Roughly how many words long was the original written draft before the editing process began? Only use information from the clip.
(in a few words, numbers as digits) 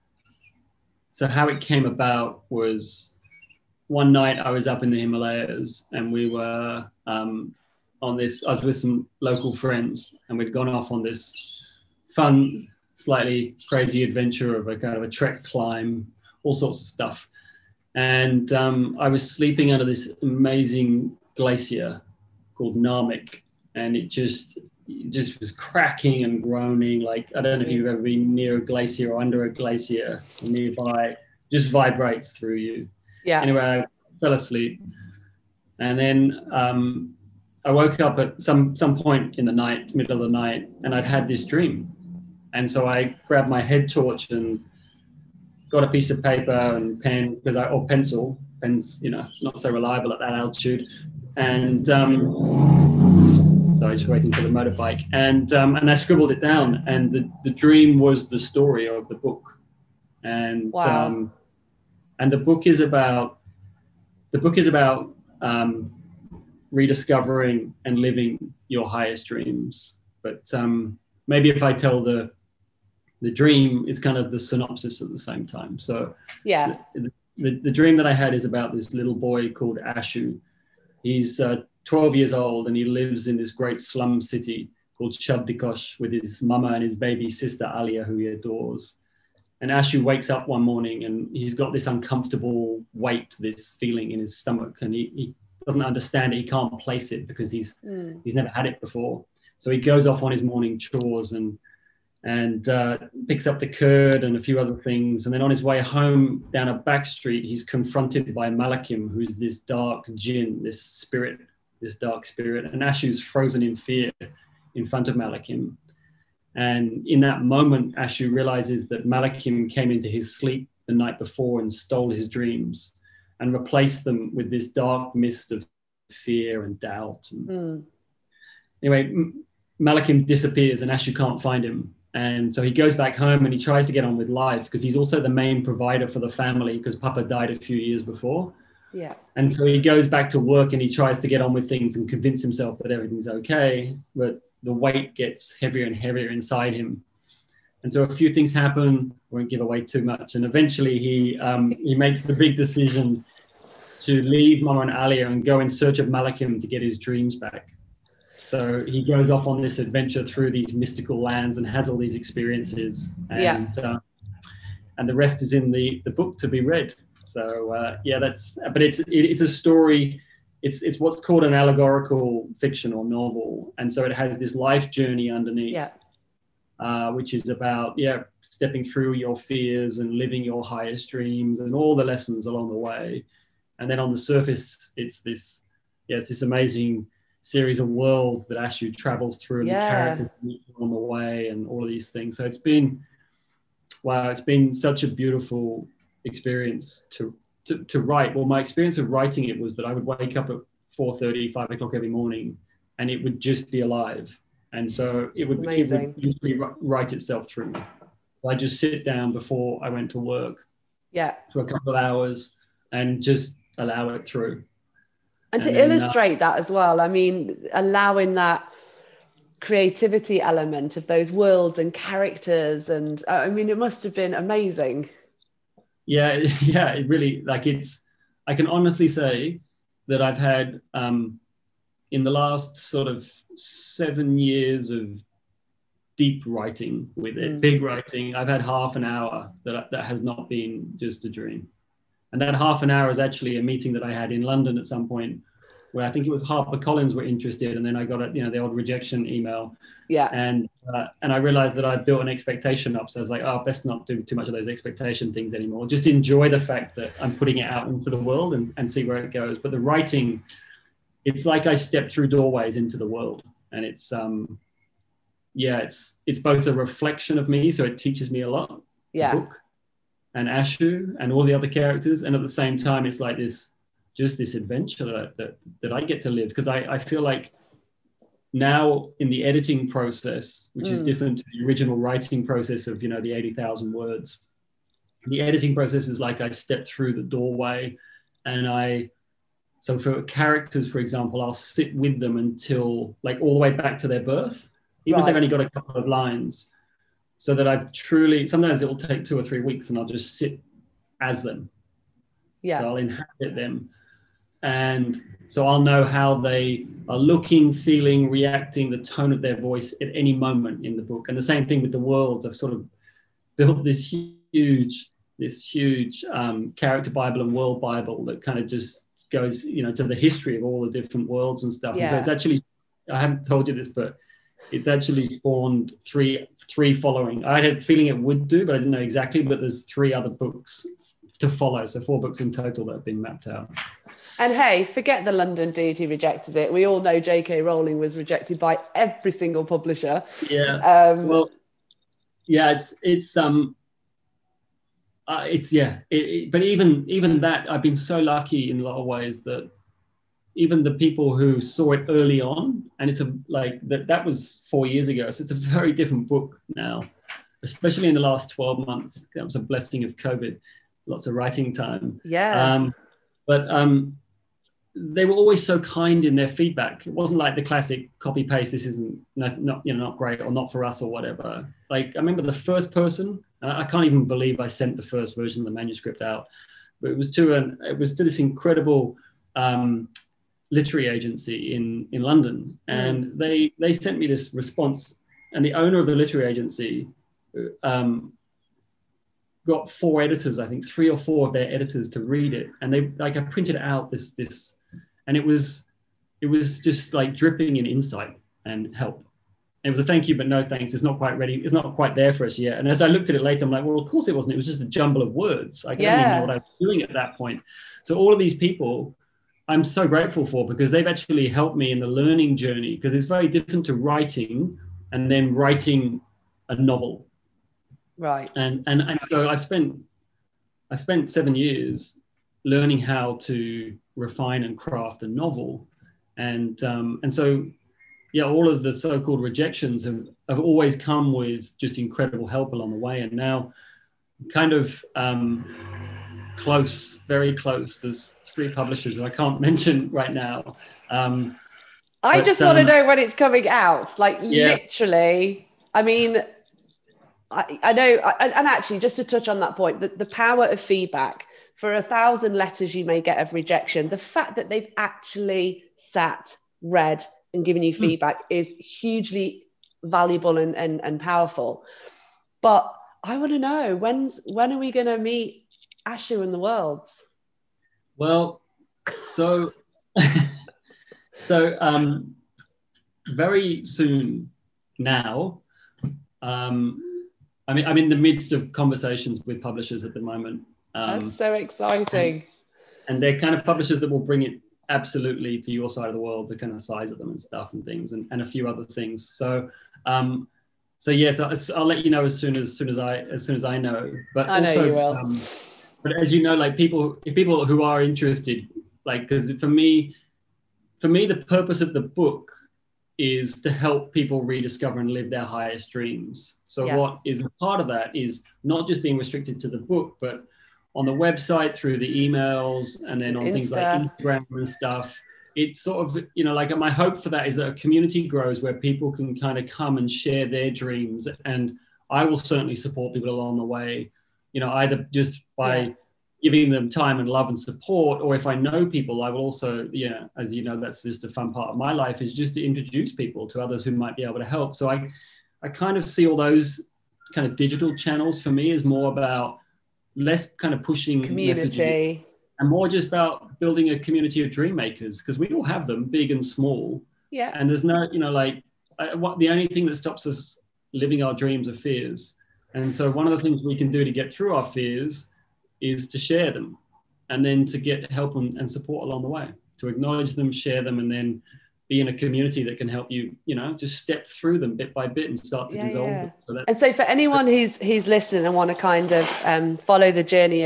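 80,000.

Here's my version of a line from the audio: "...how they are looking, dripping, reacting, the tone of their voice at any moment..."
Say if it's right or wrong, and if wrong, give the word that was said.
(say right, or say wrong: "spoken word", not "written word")
wrong: "feeling", not "dripping".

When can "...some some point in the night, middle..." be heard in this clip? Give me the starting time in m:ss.
0:38.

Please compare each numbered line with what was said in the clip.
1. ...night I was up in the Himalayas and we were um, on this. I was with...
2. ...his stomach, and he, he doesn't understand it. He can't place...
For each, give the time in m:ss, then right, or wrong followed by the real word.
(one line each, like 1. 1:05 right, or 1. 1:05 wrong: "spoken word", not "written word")
1. 0:04 right
2. 1:34 right.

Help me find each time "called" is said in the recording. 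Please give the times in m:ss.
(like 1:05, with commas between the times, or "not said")
0:22, 1:19, 1:24, 2:51, 7:08.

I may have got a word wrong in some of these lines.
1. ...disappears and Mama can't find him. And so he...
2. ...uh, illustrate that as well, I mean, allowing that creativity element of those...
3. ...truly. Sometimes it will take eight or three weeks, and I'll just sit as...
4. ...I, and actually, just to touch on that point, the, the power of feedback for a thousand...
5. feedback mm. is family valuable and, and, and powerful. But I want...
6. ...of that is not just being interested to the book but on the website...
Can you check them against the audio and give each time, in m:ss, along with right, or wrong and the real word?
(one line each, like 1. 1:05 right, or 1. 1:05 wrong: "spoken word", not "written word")
1. 2:10 wrong: "Ashu", not "Mama"
2. 3:35 right
3. 4:57 wrong: "two", not "eight"
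4. 7:28 right
5. 7:38 wrong: "hugely", not "family"
6. 8:27 wrong: "restricted", not "interested".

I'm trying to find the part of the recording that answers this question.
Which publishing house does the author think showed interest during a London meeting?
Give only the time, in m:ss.
4:06.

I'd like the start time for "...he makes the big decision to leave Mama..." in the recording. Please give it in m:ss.
2:31.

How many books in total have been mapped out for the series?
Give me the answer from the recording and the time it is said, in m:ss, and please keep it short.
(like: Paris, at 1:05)
4, at 5:31.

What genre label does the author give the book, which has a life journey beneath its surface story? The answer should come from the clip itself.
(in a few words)
allegorical fiction.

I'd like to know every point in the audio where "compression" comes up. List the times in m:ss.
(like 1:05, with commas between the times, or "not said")
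not said.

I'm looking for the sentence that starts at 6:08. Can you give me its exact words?
This isn't not, not you know not great or not for us or whatever.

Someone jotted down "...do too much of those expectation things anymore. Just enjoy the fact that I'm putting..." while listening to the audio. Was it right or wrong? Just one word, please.
right.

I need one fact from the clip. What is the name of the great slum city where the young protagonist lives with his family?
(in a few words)
Shabdikosh.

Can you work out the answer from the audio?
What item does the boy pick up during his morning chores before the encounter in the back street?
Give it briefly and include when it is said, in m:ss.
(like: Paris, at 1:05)
curd, at 1:43.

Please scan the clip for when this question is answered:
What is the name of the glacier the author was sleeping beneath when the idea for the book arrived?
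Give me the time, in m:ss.
0:22.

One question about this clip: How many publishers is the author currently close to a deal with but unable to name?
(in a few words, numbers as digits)
3.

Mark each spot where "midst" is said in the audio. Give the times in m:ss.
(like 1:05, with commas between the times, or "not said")
7:58.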